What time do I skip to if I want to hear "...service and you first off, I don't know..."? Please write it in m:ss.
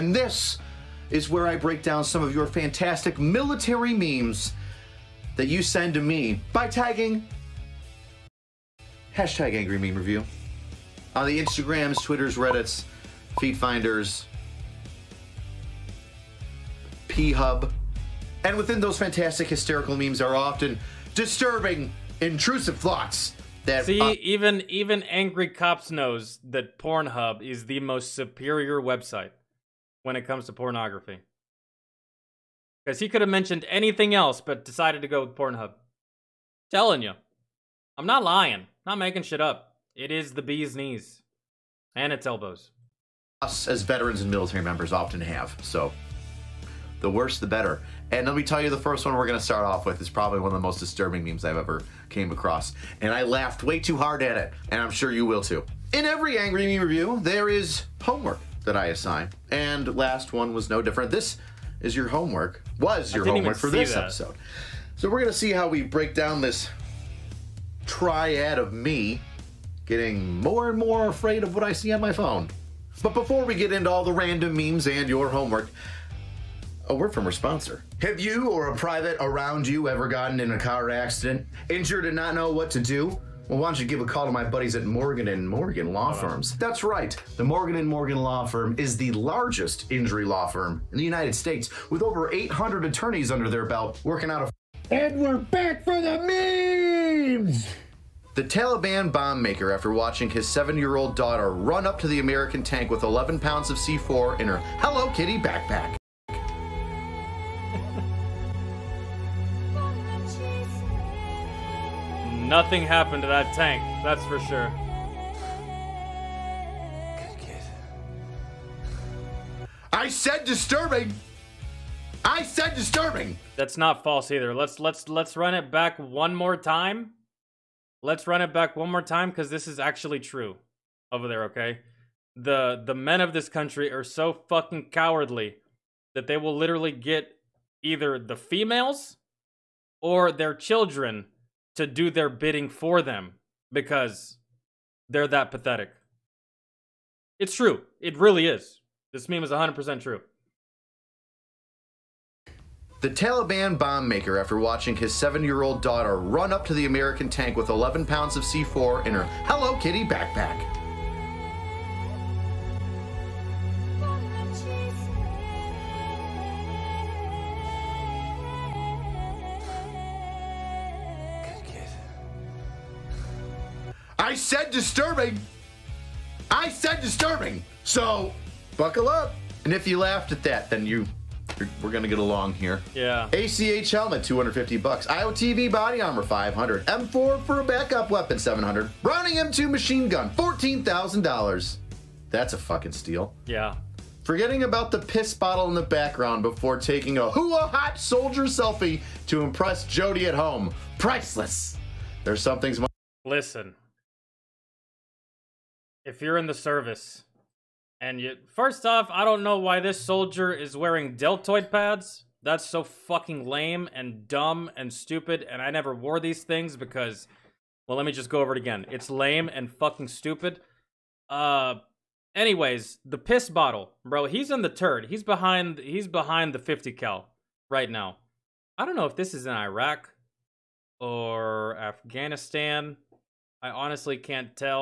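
3:26.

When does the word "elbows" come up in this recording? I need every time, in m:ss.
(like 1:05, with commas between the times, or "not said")
0:42.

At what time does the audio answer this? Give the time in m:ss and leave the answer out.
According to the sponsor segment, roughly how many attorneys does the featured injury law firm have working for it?
1:32.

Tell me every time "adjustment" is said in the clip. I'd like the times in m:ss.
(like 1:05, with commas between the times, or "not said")
not said.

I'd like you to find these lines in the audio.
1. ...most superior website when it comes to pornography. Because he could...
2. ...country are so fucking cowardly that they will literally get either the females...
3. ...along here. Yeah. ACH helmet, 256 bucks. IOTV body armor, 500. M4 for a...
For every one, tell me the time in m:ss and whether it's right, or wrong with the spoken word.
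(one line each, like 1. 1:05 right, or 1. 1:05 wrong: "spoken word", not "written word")
1. 0:27 right
2. 2:13 right
3. 3:02 wrong: "250", not "256".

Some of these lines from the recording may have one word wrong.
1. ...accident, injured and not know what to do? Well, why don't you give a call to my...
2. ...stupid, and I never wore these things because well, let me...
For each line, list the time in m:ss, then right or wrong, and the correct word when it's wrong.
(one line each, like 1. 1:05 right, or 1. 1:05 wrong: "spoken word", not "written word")
1. 1:20 right
2. 3:34 right.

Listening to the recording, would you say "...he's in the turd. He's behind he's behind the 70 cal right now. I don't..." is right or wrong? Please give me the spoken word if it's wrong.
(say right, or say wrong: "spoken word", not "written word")
wrong: "50", not "70".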